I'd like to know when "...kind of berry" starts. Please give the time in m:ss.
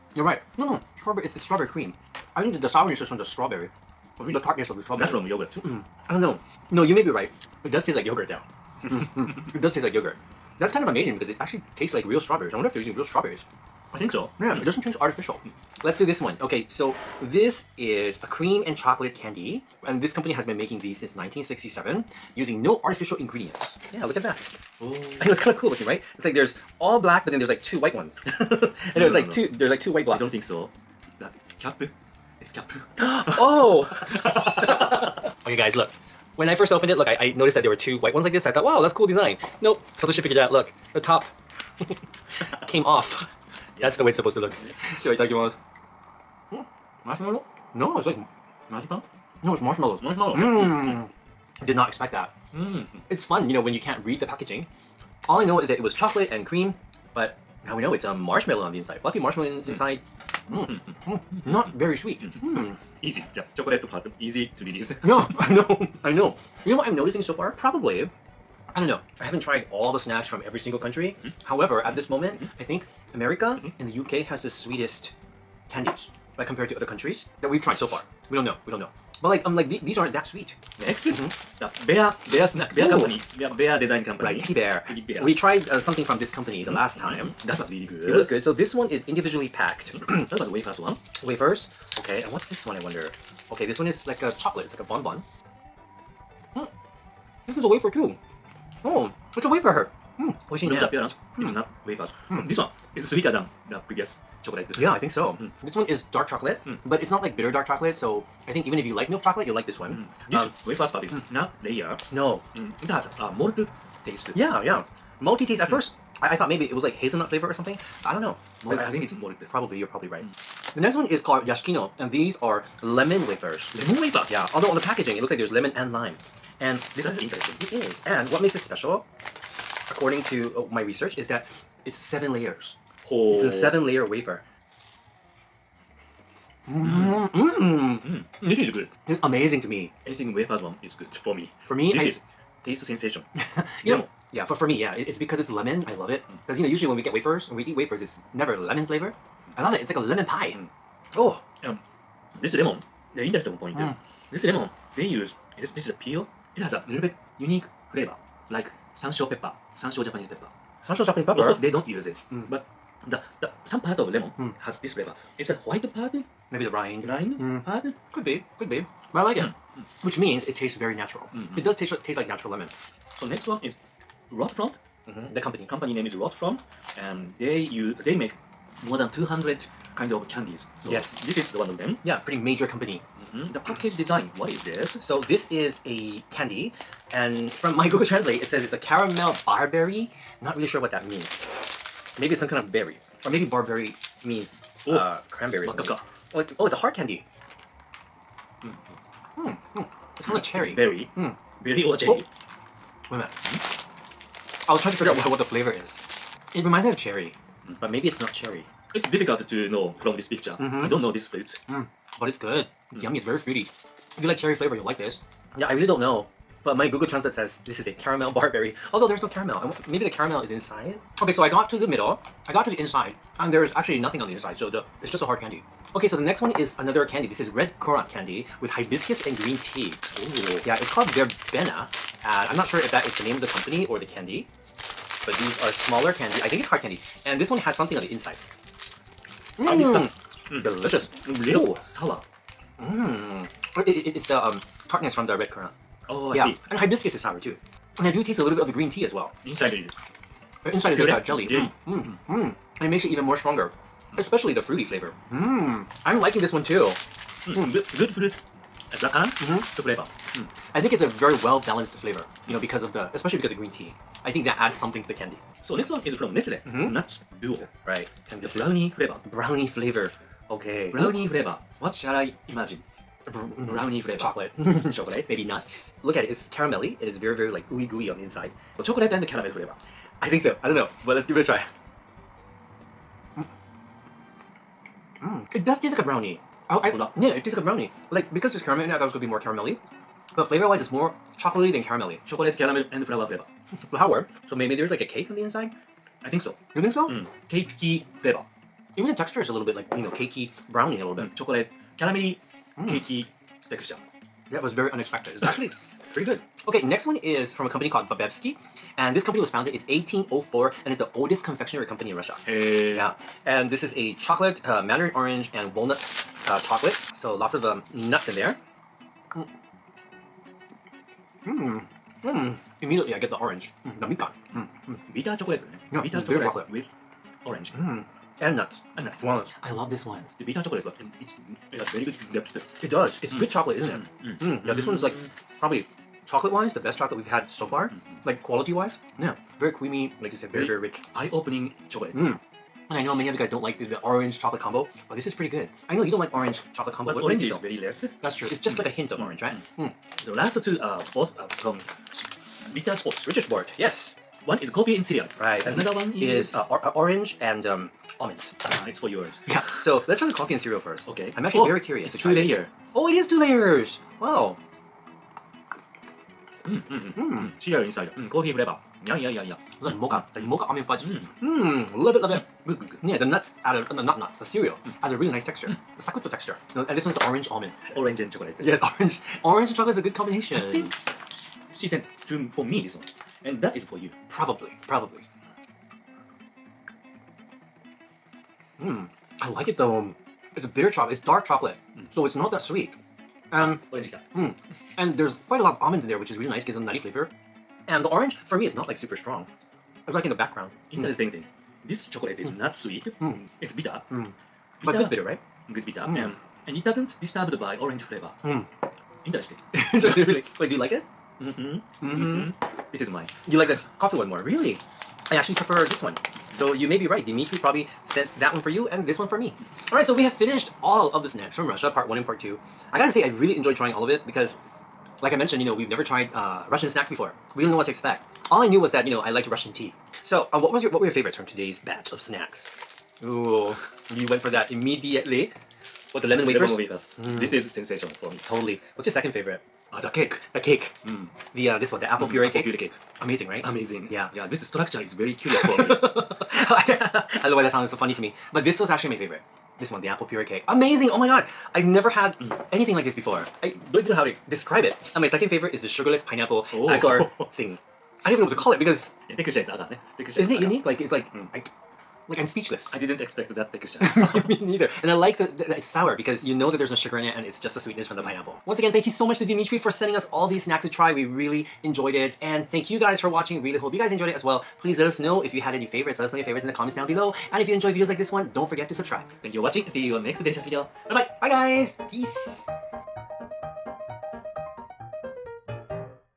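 3:12.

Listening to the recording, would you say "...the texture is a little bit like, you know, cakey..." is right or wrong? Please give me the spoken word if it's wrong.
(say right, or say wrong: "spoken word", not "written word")
right.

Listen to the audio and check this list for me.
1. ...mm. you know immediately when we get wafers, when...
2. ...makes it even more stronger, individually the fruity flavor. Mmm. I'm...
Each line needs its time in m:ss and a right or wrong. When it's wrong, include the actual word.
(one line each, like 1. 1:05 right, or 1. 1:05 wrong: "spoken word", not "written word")
1. 2:26 wrong: "usually", not "immediately"
2. 4:12 wrong: "especially", not "individually".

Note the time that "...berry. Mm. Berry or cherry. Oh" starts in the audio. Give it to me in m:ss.
3:20.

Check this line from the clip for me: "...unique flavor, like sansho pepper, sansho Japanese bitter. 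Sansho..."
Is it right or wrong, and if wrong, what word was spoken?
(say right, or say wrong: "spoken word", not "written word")
wrong: "pepper", not "bitter".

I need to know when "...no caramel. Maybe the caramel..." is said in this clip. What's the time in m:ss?
3:39.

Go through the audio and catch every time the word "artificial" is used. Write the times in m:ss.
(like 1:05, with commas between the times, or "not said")
0:14, 0:22.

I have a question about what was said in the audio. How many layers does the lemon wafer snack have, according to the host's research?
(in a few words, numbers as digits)
7.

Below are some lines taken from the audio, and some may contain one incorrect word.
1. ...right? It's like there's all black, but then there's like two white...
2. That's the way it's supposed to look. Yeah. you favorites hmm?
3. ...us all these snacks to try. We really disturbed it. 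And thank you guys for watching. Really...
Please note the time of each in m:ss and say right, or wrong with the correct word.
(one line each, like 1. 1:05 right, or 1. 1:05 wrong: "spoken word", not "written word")
1. 0:25 right
2. 0:43 wrong: "takes", not "favorites"
3. 7:50 wrong: "enjoyed", not "disturbed".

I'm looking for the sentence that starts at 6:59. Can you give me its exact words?
Alright, so we have finished all of the snacks from Russia, part one and part two.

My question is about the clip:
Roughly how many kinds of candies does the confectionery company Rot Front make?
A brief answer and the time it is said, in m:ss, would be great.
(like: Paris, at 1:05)
More than 200, at 2:58.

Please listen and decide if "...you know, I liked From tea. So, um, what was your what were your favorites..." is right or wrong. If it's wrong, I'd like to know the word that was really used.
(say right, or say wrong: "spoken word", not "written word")
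wrong: "Russian", not "From".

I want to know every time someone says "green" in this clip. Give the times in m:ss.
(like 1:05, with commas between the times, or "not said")
3:49, 4:08, 4:23.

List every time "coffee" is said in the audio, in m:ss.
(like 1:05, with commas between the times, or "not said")
5:54, 6:00, 6:08, 6:53.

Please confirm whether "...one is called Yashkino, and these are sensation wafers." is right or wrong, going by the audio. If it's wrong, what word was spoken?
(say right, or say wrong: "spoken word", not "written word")
wrong: "lemon", not "sensation".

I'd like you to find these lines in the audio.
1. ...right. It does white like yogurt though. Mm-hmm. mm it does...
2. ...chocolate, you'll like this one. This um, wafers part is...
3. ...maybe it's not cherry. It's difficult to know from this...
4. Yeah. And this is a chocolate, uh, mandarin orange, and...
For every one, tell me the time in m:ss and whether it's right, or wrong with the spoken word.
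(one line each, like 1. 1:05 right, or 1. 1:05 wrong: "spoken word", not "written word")
1. 0:07 wrong: "taste", not "white"
2. 1:49 right
3. 3:27 right
4. 5:12 right.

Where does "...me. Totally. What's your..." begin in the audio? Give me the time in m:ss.
7:18.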